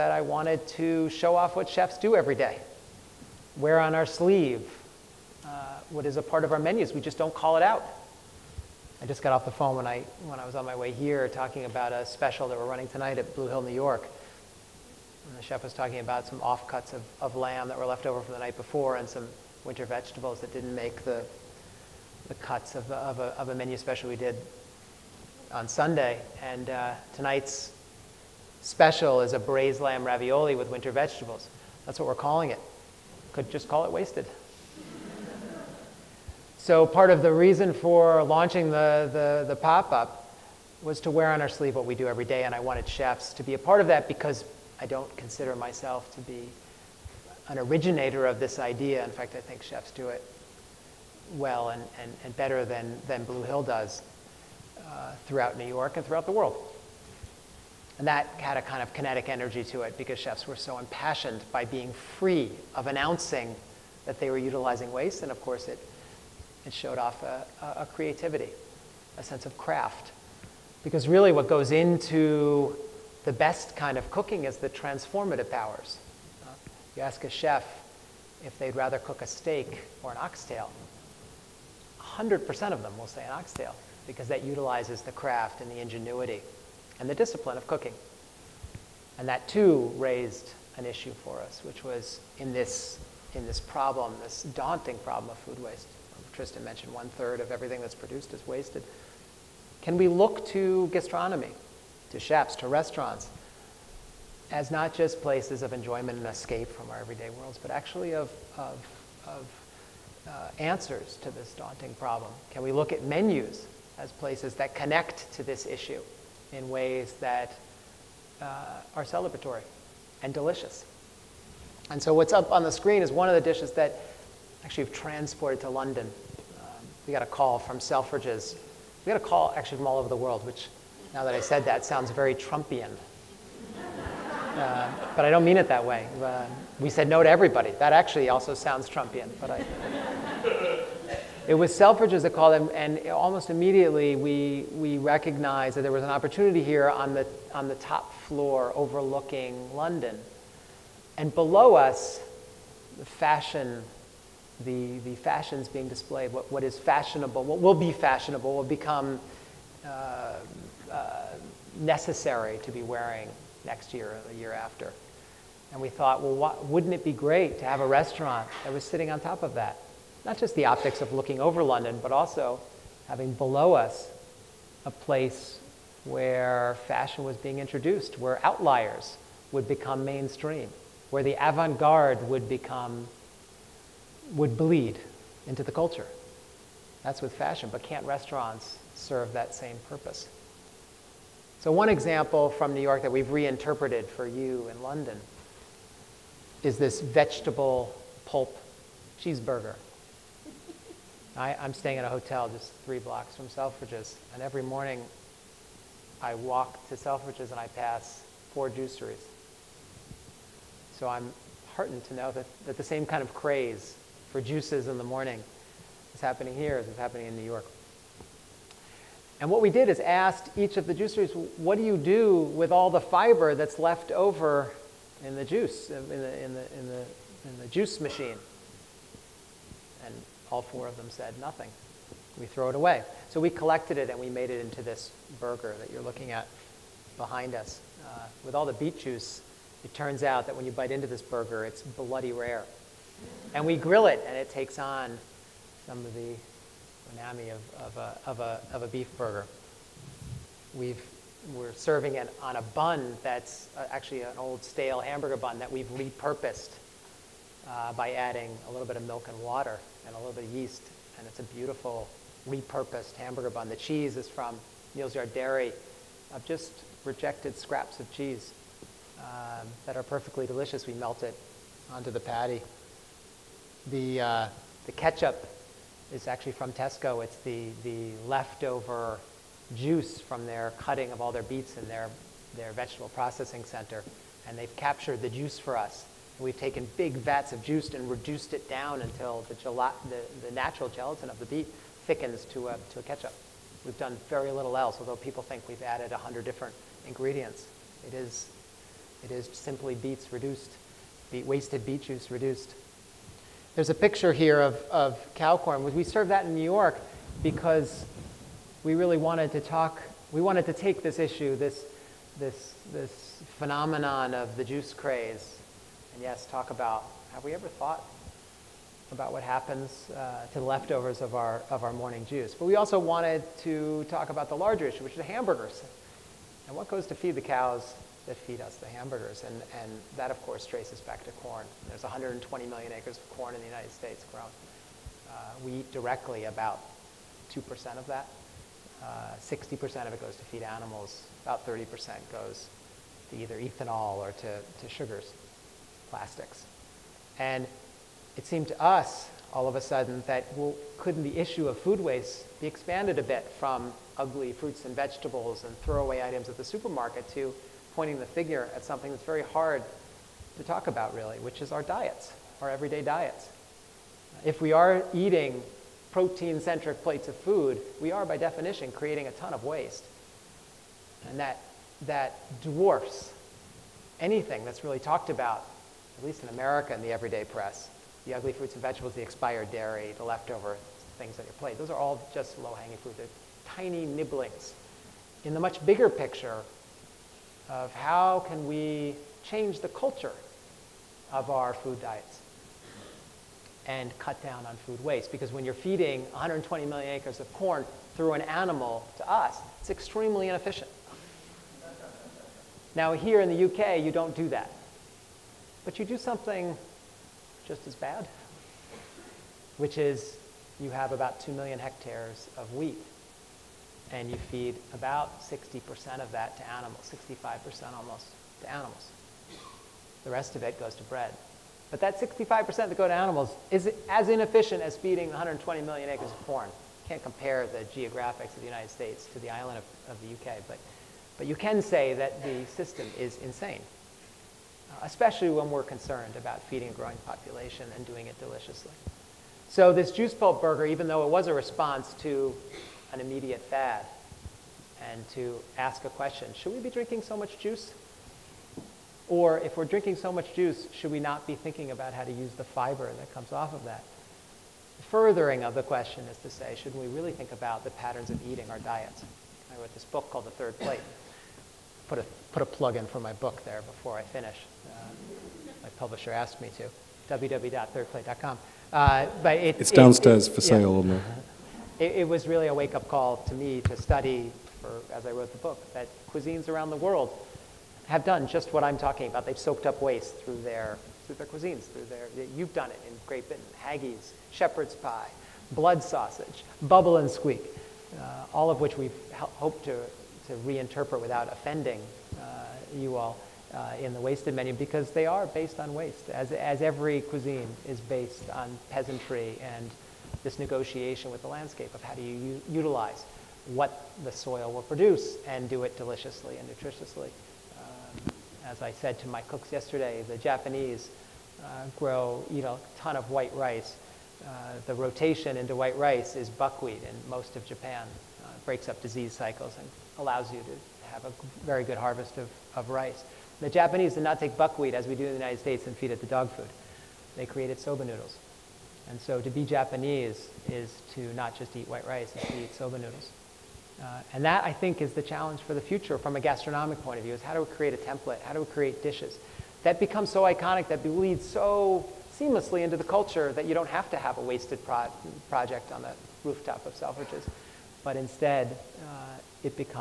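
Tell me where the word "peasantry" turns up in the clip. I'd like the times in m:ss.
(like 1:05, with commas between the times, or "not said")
8:18.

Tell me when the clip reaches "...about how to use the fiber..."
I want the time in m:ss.
7:31.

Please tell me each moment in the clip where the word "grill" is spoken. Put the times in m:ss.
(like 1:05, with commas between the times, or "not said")
4:03.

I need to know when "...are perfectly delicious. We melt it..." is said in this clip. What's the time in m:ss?
4:29.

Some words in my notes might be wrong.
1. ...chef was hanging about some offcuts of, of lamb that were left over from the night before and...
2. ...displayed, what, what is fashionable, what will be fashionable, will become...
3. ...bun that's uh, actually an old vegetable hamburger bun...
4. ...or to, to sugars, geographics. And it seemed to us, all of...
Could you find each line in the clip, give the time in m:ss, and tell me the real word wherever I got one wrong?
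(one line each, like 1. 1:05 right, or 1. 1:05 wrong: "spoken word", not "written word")
1. 0:15 wrong: "talking", not "hanging"
2. 2:35 right
3. 4:12 wrong: "stale", not "vegetable"
4. 5:44 wrong: "plastics", not "geographics".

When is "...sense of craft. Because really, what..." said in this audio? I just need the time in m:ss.
1:09.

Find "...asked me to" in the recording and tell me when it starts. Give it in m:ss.
7:46.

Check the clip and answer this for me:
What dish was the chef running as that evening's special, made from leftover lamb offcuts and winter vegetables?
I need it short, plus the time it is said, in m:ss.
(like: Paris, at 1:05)
braised lamb ravioli, at 0:29.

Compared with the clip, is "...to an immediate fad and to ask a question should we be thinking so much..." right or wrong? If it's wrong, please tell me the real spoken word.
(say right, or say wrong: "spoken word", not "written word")
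wrong: "drinking", not "thinking".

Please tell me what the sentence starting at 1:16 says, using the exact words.
You ask a chef if they'd rather cook a steak or an oxtail.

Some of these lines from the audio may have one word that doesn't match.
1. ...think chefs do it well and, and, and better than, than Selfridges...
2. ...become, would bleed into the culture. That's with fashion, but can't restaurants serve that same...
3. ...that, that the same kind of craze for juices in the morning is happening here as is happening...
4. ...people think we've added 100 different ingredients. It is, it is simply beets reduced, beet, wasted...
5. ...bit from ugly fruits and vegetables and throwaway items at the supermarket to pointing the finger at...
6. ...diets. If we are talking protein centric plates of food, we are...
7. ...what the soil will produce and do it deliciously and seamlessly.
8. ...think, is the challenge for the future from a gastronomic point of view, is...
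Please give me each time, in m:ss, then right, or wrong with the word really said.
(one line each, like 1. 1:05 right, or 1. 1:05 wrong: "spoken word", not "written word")
1. 0:49 wrong: "Blue", not "Selfridges"
2. 3:02 right
3. 3:32 right
4. 4:55 right
5. 5:53 right
6. 6:03 wrong: "eating", not "talking"
7. 8:23 wrong: "nutritiously", not "seamlessly"
8. 8:54 right.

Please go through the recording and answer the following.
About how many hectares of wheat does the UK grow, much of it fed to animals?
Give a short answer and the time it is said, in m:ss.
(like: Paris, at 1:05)
2 million hectares, at 6:51.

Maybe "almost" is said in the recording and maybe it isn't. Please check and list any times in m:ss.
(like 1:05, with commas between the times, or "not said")
2:23, 6:57.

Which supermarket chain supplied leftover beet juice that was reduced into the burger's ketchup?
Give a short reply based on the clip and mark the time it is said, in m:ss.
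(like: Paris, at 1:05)
Tesco, at 4:36.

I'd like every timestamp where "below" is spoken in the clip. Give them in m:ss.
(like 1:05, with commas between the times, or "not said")
2:31, 2:53.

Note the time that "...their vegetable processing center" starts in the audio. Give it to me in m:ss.
4:42.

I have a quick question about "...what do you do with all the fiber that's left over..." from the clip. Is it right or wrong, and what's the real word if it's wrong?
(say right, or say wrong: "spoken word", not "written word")
right.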